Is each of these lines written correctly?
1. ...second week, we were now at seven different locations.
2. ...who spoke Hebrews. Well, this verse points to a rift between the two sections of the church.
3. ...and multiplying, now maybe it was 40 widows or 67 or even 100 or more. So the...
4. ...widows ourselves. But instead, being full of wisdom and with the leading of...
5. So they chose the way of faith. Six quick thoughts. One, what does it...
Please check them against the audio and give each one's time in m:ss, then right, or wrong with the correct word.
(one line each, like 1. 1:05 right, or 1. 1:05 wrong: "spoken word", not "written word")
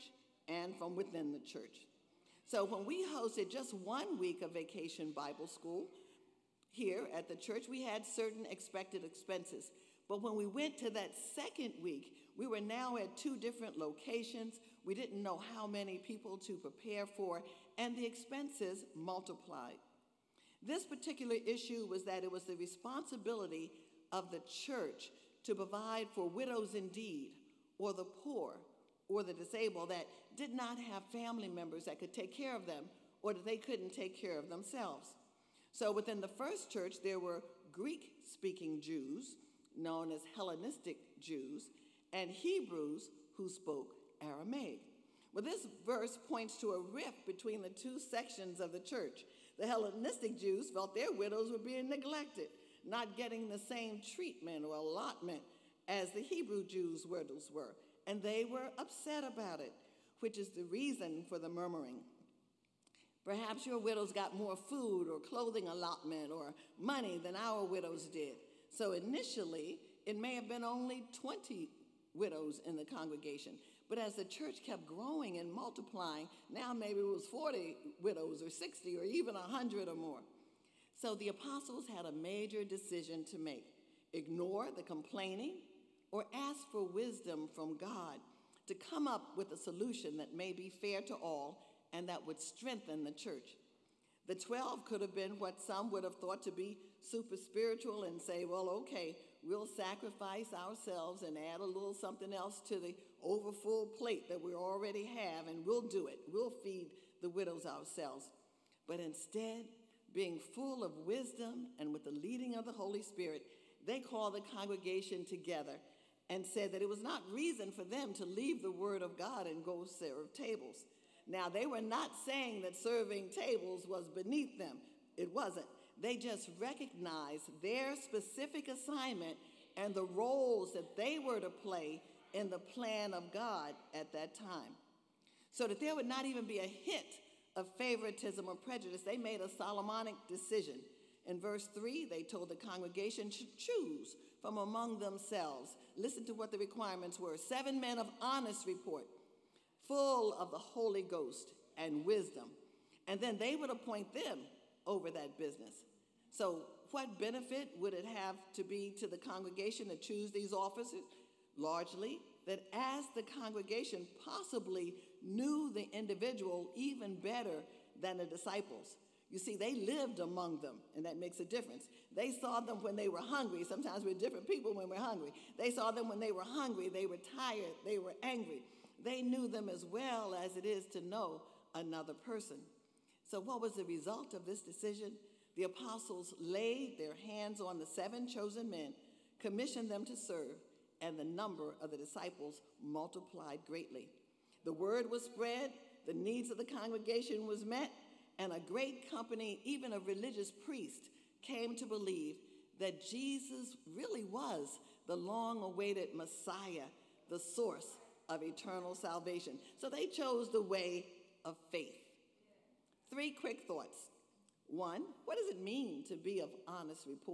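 1. 0:11 wrong: "two", not "seven"
2. 0:43 wrong: "Aramaic", not "Hebrews"
3. 1:15 wrong: "60", not "67"
4. 1:47 right
5. 3:29 wrong: "Three", not "Six".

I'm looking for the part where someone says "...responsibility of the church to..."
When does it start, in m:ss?
0:22.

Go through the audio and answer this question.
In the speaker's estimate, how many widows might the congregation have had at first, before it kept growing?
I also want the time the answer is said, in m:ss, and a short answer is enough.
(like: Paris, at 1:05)
20, at 1:11.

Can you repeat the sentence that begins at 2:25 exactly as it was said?
Listen to what the requirements were seven men of honest report, full of the Holy Ghost and wisdom.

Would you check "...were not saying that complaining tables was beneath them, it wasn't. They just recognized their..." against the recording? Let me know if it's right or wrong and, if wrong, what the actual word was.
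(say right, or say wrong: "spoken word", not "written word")
wrong: "serving", not "complaining".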